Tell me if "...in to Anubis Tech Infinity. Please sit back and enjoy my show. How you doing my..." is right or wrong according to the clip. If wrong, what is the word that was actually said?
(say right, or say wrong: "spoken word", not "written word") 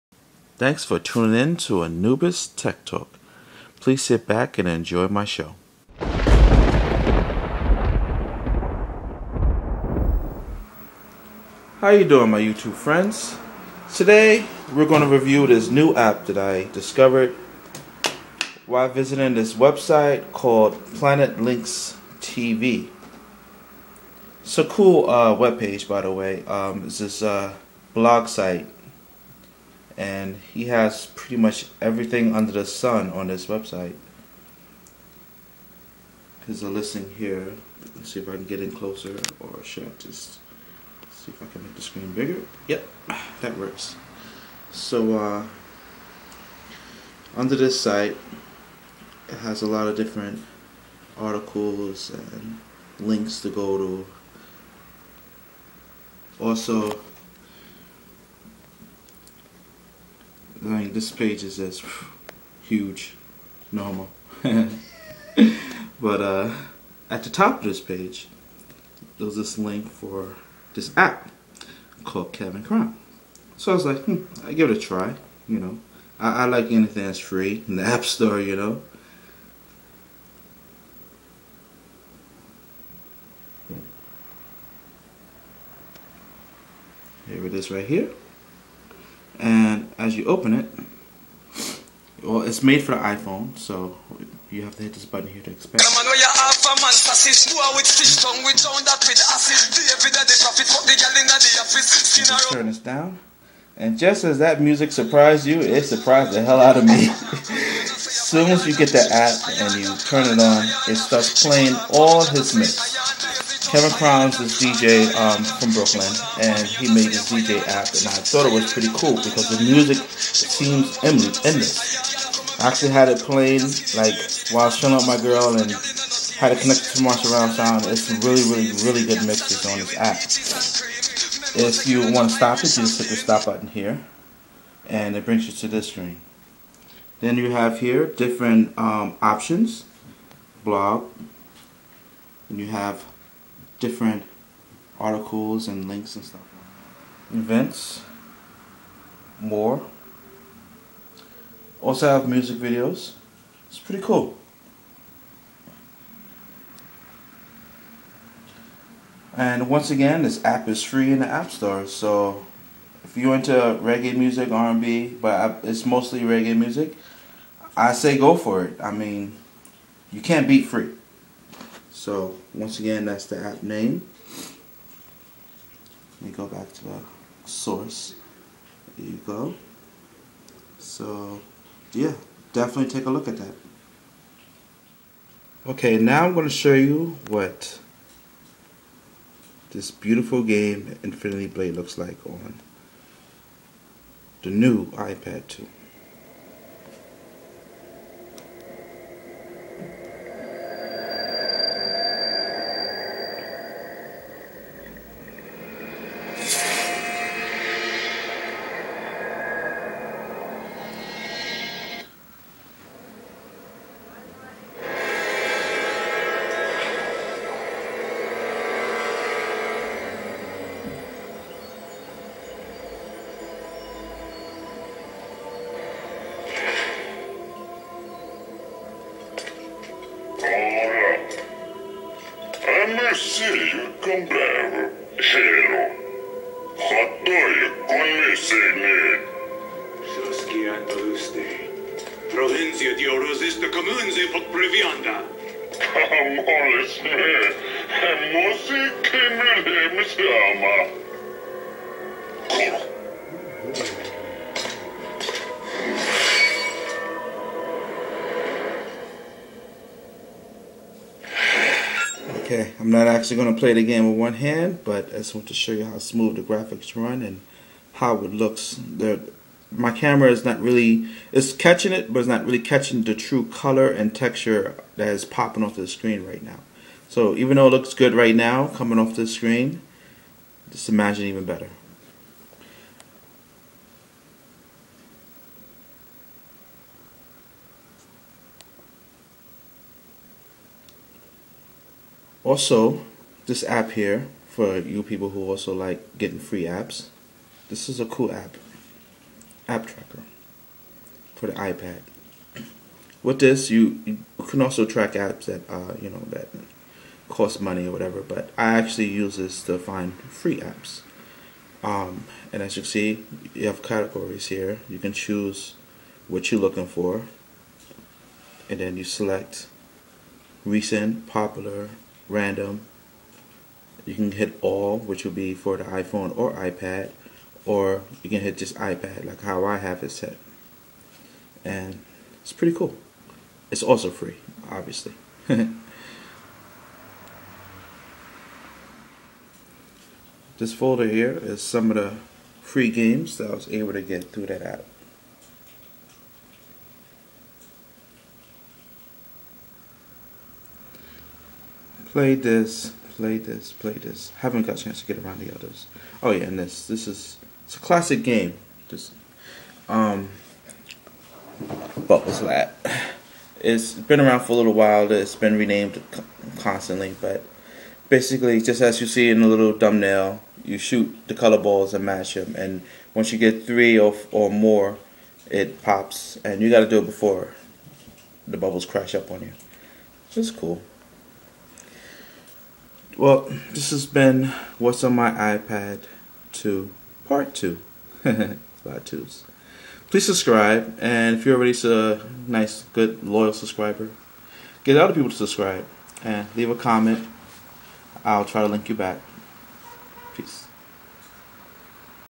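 wrong: "Talk", not "Infinity".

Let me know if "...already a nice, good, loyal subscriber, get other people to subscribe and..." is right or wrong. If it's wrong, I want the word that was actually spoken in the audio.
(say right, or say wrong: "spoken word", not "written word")
right.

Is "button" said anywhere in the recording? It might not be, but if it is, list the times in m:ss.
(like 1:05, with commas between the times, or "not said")
1:35, 2:13.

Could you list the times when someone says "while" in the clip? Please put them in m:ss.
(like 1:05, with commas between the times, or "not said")
0:18, 2:04, 6:04.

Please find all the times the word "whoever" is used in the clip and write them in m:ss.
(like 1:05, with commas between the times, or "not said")
not said.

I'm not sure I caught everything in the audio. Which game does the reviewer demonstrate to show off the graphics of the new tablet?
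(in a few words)
Infinity Blade.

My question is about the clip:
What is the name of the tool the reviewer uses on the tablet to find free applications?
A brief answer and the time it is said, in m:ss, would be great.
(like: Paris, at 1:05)
App tracker, at 4:59.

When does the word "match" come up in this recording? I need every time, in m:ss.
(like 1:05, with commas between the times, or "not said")
6:12.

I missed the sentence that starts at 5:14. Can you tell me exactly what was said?
You can choose what you're looking for, and then you select recent, popular, random.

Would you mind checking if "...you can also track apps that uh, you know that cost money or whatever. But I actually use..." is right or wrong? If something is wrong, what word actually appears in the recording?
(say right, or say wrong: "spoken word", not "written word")
right.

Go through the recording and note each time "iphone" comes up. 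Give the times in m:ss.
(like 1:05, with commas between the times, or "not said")
1:33, 5:25.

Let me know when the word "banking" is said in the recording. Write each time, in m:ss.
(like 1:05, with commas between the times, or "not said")
not said.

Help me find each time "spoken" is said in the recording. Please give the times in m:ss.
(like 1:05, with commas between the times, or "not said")
not said.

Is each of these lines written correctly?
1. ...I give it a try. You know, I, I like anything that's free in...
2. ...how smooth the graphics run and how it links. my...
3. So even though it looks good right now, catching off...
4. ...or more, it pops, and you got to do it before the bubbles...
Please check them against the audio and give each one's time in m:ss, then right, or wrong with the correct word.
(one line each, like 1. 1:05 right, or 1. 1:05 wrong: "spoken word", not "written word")
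1. 1:14 right
2. 4:25 wrong: "looks", not "links"
3. 4:37 wrong: "coming", not "catching"
4. 6:14 right.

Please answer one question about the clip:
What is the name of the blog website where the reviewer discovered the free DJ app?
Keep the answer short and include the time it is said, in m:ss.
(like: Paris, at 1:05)
Planet Lynx TV, at 0:20.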